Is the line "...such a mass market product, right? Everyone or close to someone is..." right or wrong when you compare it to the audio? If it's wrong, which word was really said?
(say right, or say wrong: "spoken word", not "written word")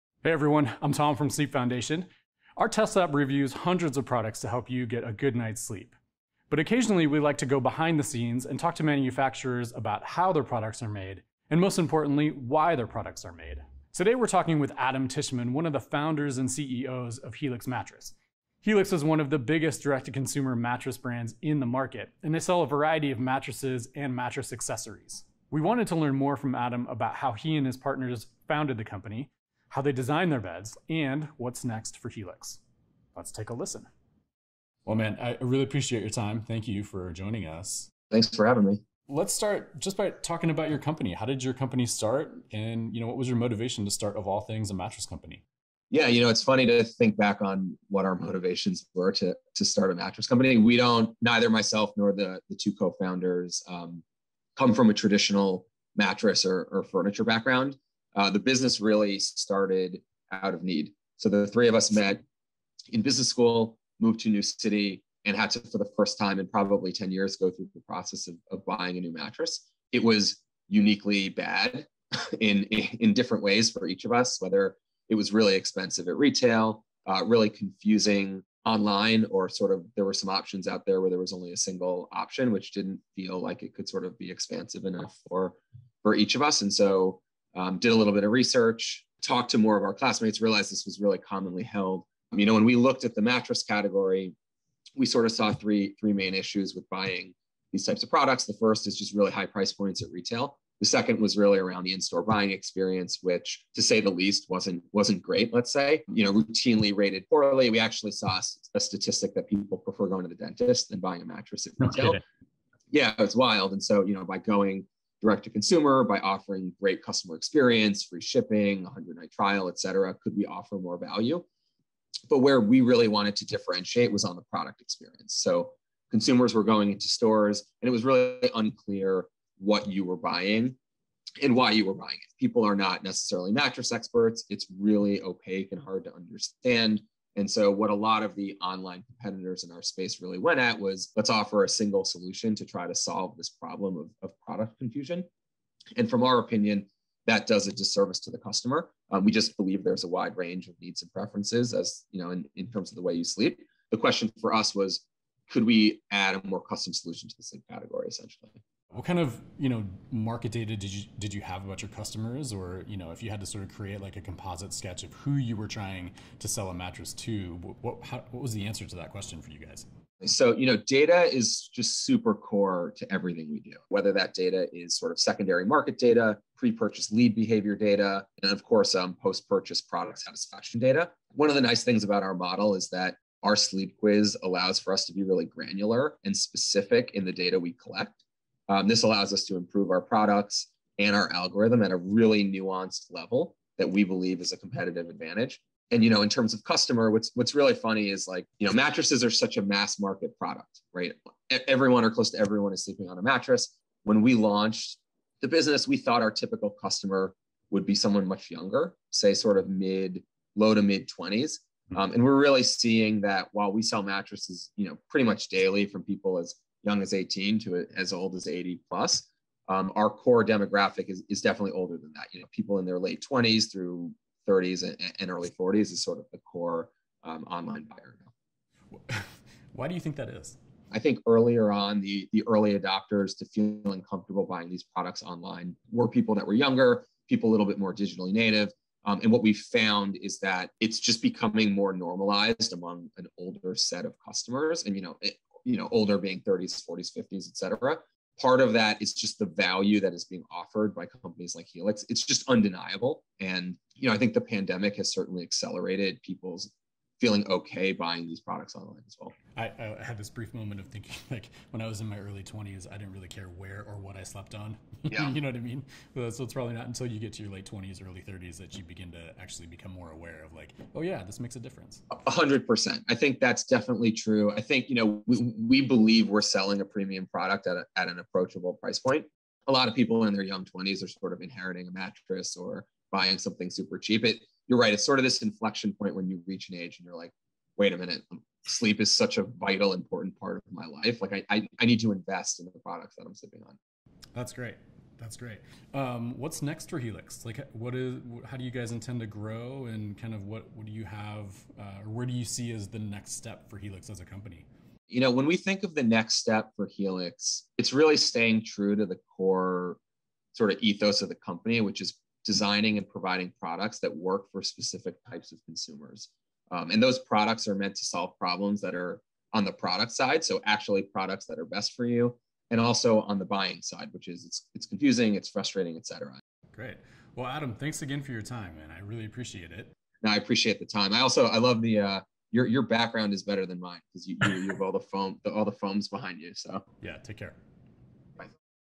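wrong: "everyone", not "someone".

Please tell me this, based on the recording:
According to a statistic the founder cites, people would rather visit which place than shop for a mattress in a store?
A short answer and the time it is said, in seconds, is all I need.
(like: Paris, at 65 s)
the dentist, at 110 s.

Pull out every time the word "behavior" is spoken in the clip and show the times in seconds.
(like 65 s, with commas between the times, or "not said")
177 s.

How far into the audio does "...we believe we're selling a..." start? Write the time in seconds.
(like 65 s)
275 s.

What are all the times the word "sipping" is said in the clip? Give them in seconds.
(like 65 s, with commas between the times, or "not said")
293 s.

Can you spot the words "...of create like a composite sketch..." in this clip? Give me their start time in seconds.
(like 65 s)
163 s.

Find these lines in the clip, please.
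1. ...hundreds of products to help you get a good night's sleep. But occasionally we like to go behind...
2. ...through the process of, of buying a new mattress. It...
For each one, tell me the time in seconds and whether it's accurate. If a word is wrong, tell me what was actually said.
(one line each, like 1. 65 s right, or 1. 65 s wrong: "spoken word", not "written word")
1. 3 s right
2. 67 s right.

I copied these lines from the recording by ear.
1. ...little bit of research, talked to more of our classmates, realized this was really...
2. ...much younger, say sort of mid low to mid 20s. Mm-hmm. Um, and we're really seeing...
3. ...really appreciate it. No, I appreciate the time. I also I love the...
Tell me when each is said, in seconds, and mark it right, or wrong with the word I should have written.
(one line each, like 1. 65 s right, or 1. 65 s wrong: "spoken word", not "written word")
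1. 87 s right
2. 208 s right
3. 329 s right.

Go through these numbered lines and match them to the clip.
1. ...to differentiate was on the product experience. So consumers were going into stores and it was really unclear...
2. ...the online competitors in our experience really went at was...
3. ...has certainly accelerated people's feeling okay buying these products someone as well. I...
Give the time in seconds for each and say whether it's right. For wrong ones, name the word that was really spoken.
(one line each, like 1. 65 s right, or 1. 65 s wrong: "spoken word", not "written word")
1. 123 s right
2. 138 s wrong: "space", not "experience"
3. 254 s wrong: "online", not "someone".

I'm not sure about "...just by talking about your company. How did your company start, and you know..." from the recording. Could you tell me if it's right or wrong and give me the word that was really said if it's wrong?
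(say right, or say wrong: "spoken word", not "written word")
right.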